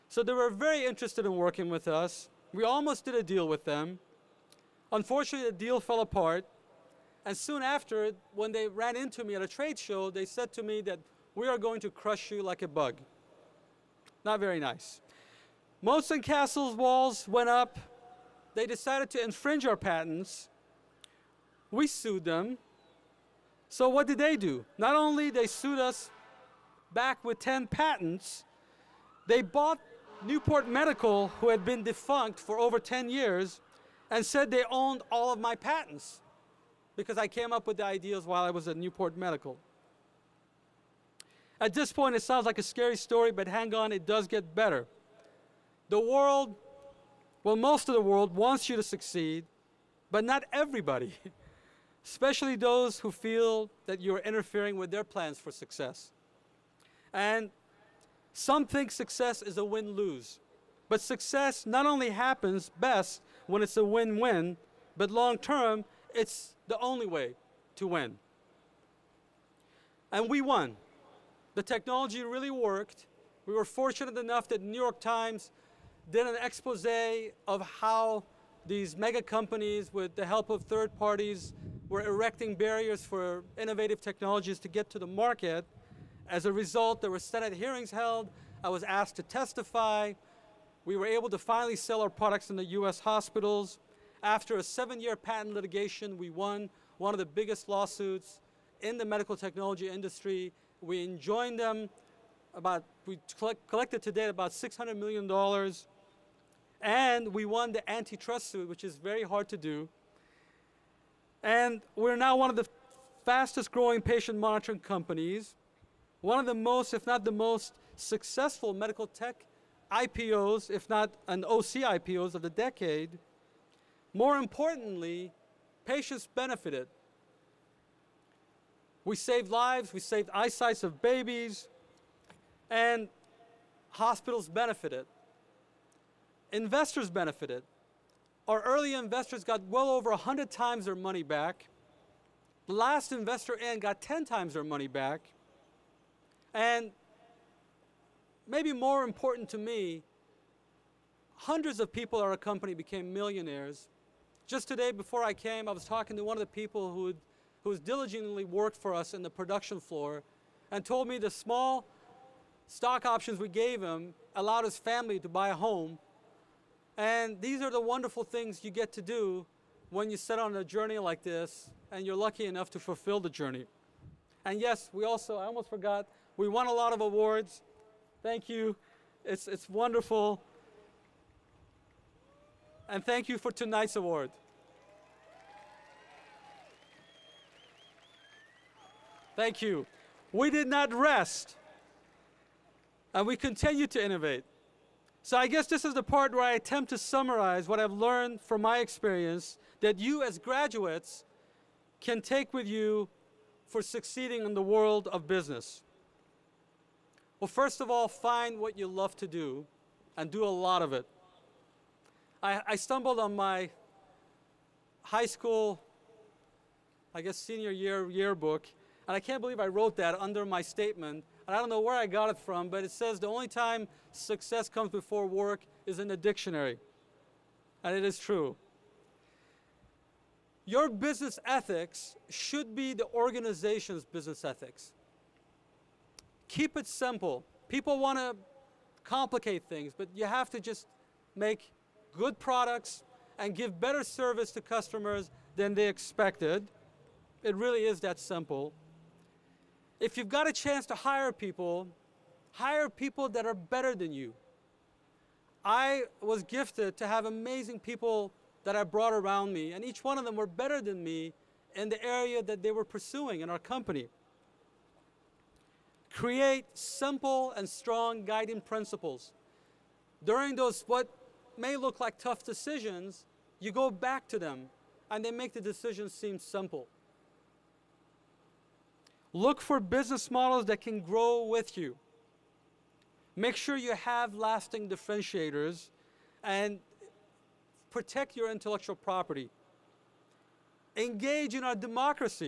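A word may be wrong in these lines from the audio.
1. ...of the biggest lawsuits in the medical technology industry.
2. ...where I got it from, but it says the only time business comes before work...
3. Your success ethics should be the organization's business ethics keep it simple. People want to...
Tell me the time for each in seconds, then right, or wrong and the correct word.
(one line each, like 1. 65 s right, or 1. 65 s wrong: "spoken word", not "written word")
1. 97 s right
2. 221 s wrong: "success", not "business"
3. 230 s wrong: "business", not "success".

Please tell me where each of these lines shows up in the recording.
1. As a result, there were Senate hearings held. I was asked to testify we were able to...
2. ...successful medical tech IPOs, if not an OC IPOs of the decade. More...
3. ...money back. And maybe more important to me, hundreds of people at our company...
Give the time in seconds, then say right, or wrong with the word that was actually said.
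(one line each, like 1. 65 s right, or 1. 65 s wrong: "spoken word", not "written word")
1. 86 s right
2. 117 s right
3. 144 s right.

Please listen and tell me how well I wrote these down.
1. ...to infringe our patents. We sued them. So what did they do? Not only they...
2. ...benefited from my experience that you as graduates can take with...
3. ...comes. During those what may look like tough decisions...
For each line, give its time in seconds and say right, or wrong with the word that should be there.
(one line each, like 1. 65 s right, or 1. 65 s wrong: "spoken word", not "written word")
1. 19 s right
2. 197 s wrong: "learned", not "benefited"
3. 268 s wrong: "principles", not "comes".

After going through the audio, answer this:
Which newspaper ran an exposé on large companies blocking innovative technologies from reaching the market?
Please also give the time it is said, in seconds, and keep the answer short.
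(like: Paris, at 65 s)
New York Times, at 74 s.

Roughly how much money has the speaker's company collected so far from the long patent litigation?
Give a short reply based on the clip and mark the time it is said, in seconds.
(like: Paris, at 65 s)
$600 million, at 104 s.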